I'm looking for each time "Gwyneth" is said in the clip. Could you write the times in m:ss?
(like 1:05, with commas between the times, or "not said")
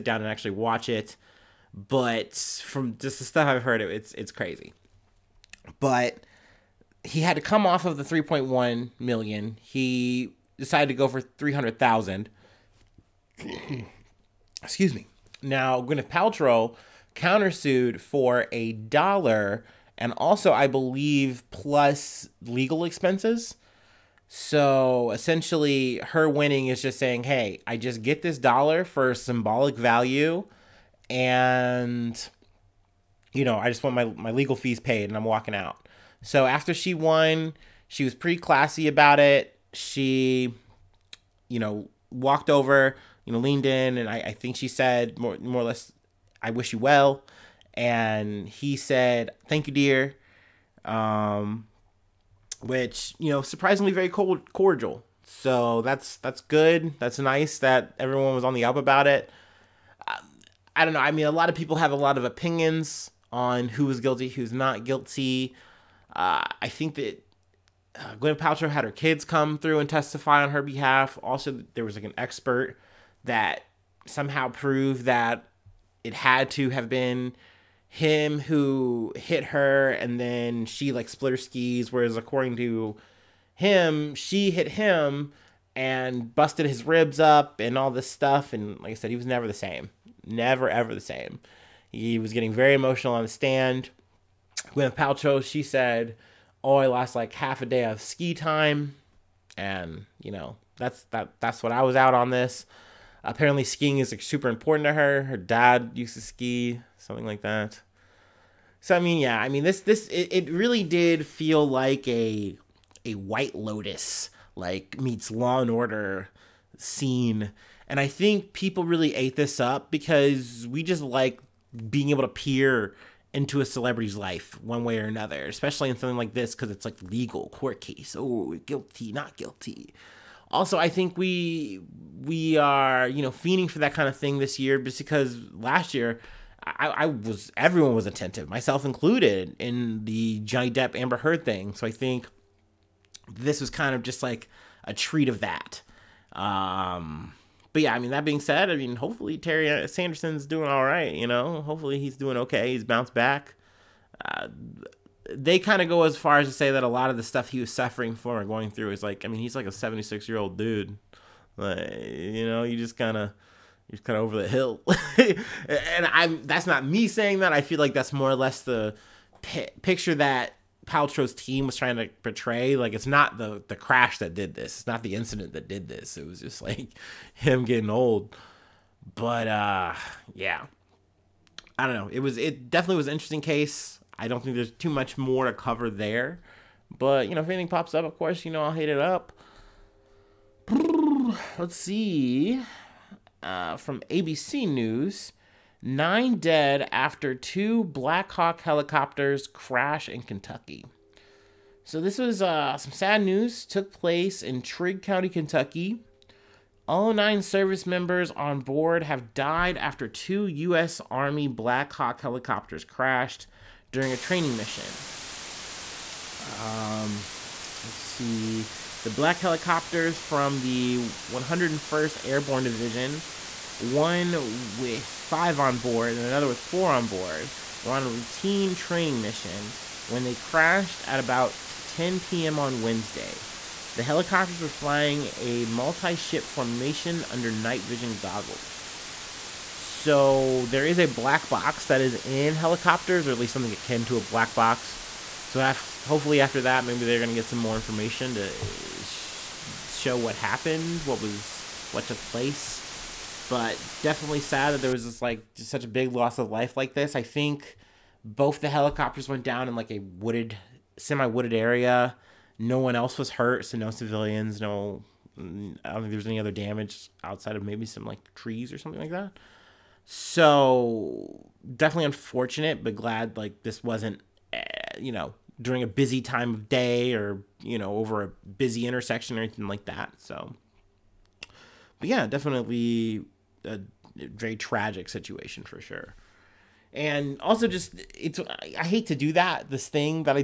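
0:15, 1:34.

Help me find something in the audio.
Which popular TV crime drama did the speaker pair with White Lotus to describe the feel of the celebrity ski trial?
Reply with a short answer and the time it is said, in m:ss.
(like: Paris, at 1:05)
Law and Order, at 1:55.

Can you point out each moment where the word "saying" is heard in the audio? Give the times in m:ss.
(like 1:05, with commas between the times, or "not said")
0:26, 2:47.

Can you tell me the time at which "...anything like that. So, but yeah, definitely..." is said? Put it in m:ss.
4:39.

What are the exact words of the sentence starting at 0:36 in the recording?
So after she won, she was pretty classy about it.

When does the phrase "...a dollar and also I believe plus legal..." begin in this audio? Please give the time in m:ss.
0:18.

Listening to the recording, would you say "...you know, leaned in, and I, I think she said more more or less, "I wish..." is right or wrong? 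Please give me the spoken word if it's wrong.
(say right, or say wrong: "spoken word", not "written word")
right.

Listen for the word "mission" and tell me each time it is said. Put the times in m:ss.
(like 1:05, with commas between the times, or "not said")
3:34, 3:49.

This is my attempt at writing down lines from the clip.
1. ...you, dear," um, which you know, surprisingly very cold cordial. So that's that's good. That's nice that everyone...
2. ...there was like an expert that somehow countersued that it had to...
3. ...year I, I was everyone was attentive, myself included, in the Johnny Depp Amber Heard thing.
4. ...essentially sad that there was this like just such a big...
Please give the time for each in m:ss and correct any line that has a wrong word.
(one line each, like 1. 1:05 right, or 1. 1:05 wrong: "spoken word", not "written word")
1. 0:49 right
2. 1:11 wrong: "proved", not "countersued"
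3. 2:15 right
4. 4:14 wrong: "definitely", not "essentially".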